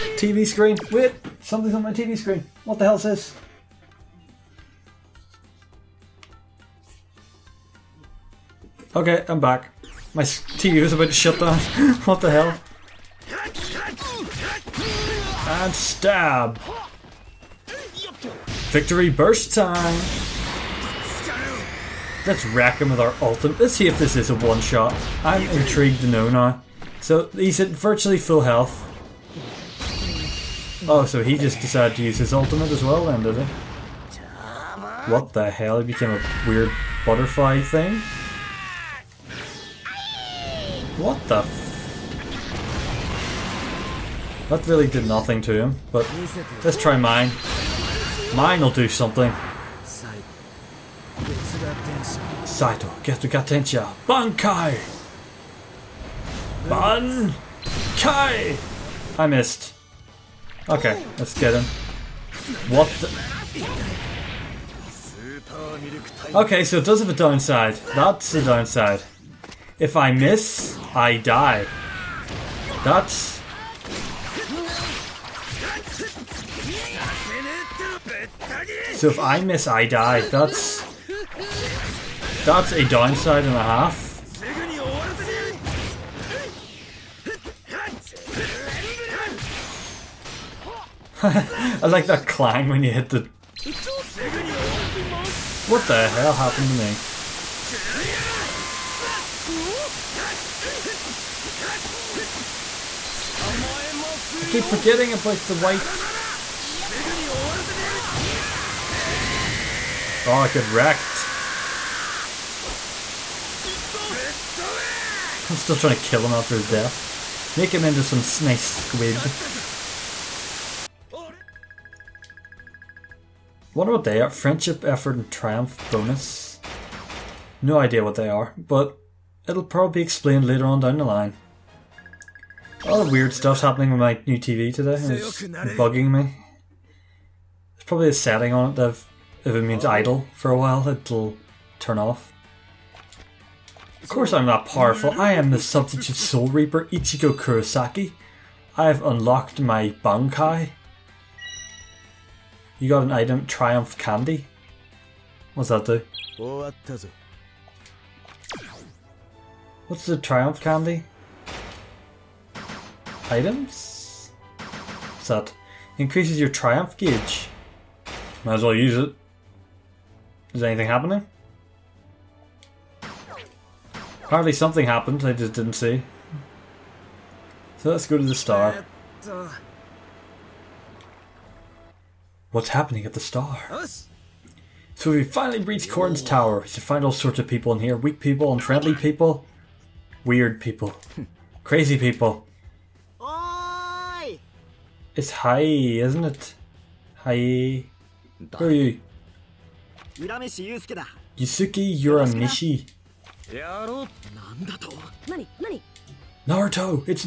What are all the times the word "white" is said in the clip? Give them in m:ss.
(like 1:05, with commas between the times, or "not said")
1:45.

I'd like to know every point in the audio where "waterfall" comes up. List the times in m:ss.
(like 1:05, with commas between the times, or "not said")
not said.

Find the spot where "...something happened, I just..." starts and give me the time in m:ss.
2:54.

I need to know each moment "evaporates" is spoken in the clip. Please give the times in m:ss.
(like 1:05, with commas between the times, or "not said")
not said.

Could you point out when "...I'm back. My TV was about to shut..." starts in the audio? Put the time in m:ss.
0:09.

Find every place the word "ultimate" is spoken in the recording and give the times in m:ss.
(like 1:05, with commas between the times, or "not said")
0:23, 0:32.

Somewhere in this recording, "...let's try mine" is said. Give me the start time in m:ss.
0:46.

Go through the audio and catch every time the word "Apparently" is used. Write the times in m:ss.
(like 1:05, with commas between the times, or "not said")
2:54.